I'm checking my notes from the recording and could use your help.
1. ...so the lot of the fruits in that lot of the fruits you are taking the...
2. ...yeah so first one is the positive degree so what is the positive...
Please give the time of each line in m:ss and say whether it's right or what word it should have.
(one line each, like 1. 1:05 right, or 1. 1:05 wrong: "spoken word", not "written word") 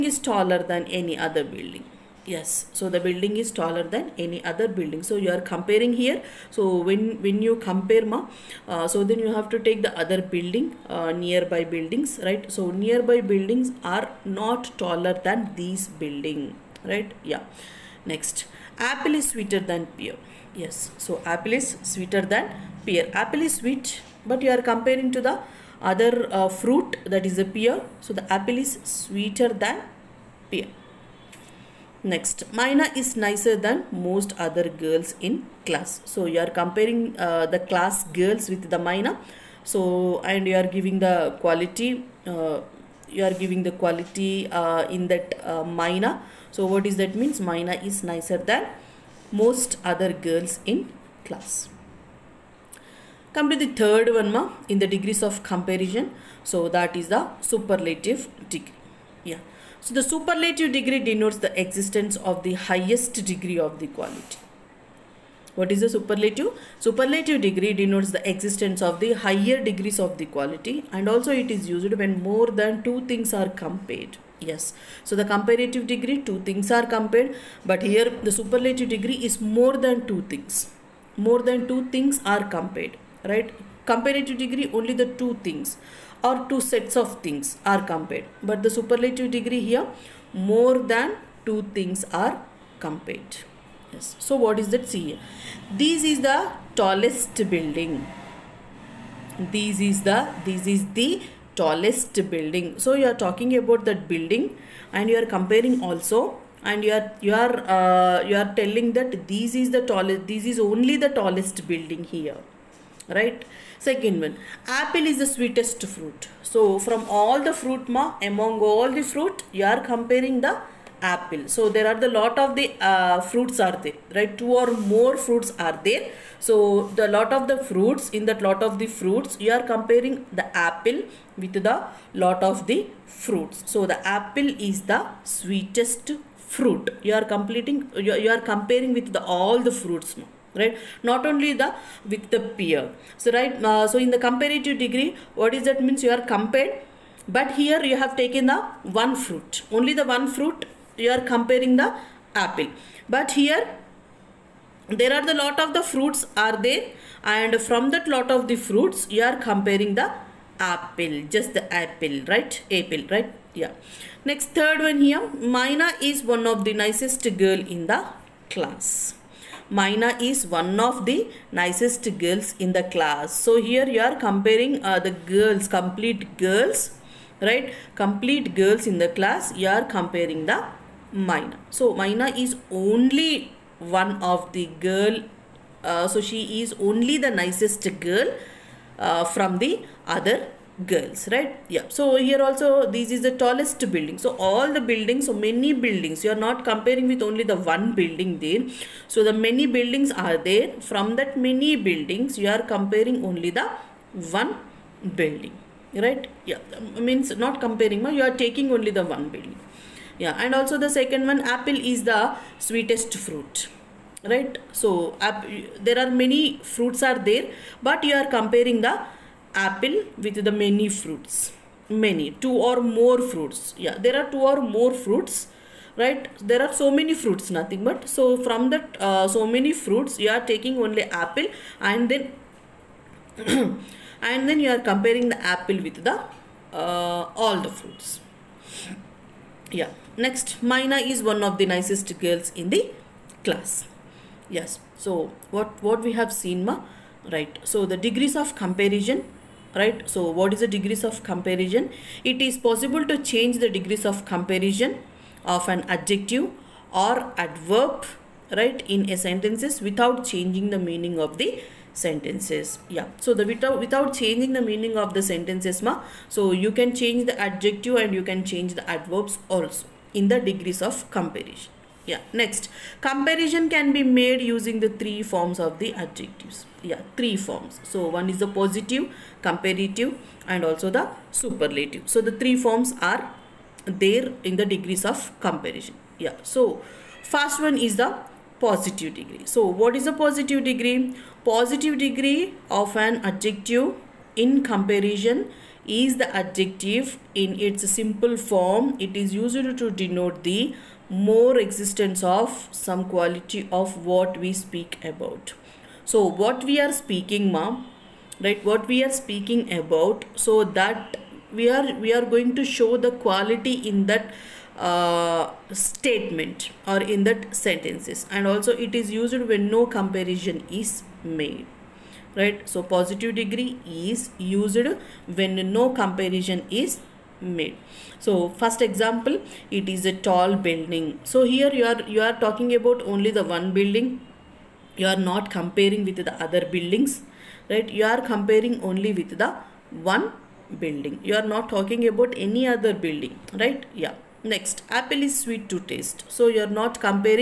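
1. 2:06 wrong: "comparing", not "taking"
2. 4:46 right.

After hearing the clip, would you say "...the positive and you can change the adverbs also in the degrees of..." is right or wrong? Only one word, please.
wrong.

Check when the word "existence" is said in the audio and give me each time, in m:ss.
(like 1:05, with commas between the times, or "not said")
1:01, 1:08, 5:01.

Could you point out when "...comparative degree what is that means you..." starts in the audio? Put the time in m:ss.
2:24.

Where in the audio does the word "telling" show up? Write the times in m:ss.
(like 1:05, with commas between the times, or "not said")
1:48.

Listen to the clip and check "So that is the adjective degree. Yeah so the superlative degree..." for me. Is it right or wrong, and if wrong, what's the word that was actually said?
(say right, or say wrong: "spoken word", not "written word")
wrong: "superlative", not "adjective".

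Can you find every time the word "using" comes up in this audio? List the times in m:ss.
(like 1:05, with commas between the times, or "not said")
4:34.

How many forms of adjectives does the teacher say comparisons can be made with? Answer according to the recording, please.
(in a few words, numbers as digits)
3.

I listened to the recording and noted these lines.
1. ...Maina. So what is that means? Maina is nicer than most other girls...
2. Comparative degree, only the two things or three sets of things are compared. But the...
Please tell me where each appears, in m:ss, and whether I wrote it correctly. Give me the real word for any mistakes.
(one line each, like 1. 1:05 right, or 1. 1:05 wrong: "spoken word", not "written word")
1. 0:45 right
2. 1:23 wrong: "two", not "three".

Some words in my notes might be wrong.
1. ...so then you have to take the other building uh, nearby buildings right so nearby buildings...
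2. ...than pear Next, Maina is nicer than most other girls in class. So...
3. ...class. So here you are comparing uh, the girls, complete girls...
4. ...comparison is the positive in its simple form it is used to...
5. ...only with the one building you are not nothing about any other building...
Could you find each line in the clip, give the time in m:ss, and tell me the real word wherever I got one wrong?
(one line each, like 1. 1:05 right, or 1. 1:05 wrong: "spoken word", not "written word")
1. 0:08 right
2. 0:29 right
3. 2:52 right
4. 4:54 wrong: "adjective", not "positive"
5. 5:38 wrong: "talking", not "nothing".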